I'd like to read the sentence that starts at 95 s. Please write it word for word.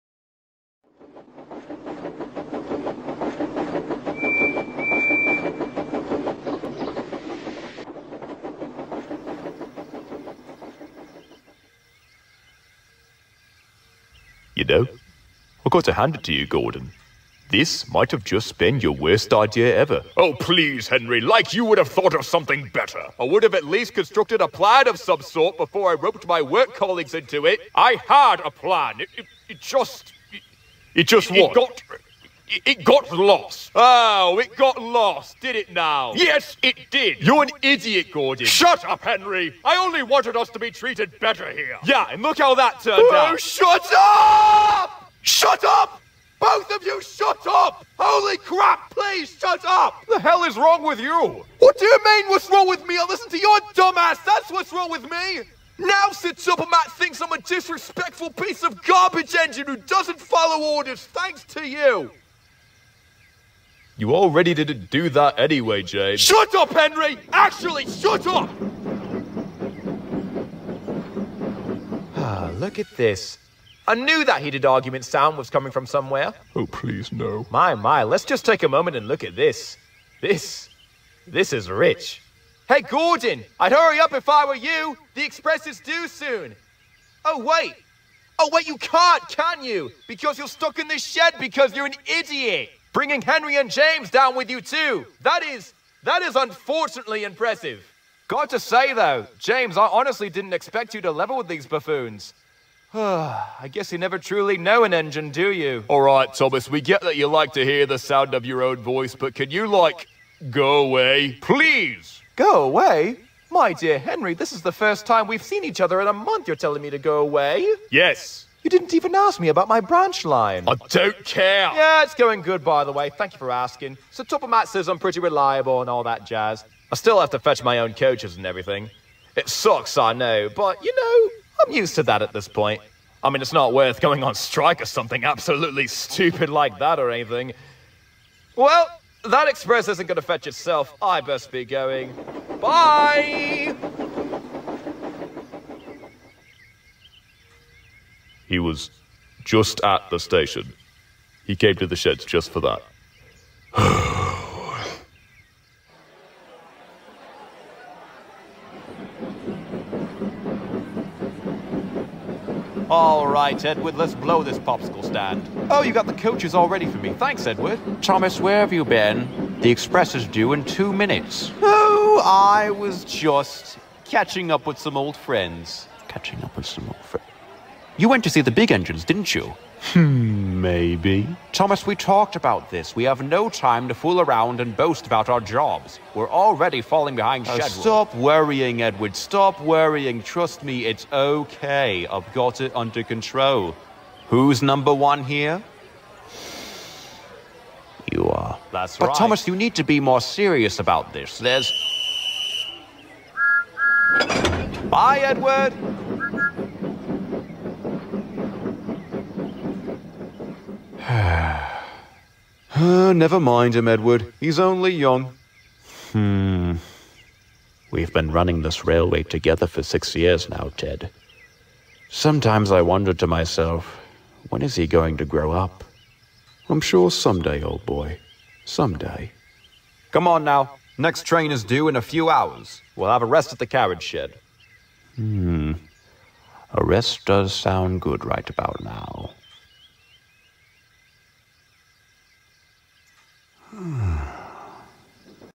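That is, that is unfortunately impressive.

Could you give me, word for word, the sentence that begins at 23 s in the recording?
I would have at least constructed a plan of some sort before I roped my work colleagues into it.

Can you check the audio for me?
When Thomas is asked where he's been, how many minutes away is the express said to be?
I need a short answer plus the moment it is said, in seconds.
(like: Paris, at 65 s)
2, at 170 s.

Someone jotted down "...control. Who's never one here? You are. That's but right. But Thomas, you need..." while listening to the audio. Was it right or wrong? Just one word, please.
wrong.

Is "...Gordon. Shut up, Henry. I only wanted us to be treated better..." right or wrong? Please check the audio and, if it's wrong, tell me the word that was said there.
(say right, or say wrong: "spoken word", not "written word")
right.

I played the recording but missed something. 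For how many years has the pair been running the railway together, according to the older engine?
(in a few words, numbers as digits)
6.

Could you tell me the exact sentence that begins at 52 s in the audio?
I listen to your dumbass, that's what's wrong with me!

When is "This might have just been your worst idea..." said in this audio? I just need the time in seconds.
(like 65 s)
17 s.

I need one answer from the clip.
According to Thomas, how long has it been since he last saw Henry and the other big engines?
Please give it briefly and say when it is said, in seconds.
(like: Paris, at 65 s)
A month, at 116 s.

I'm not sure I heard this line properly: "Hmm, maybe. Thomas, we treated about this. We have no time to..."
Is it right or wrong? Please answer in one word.
wrong.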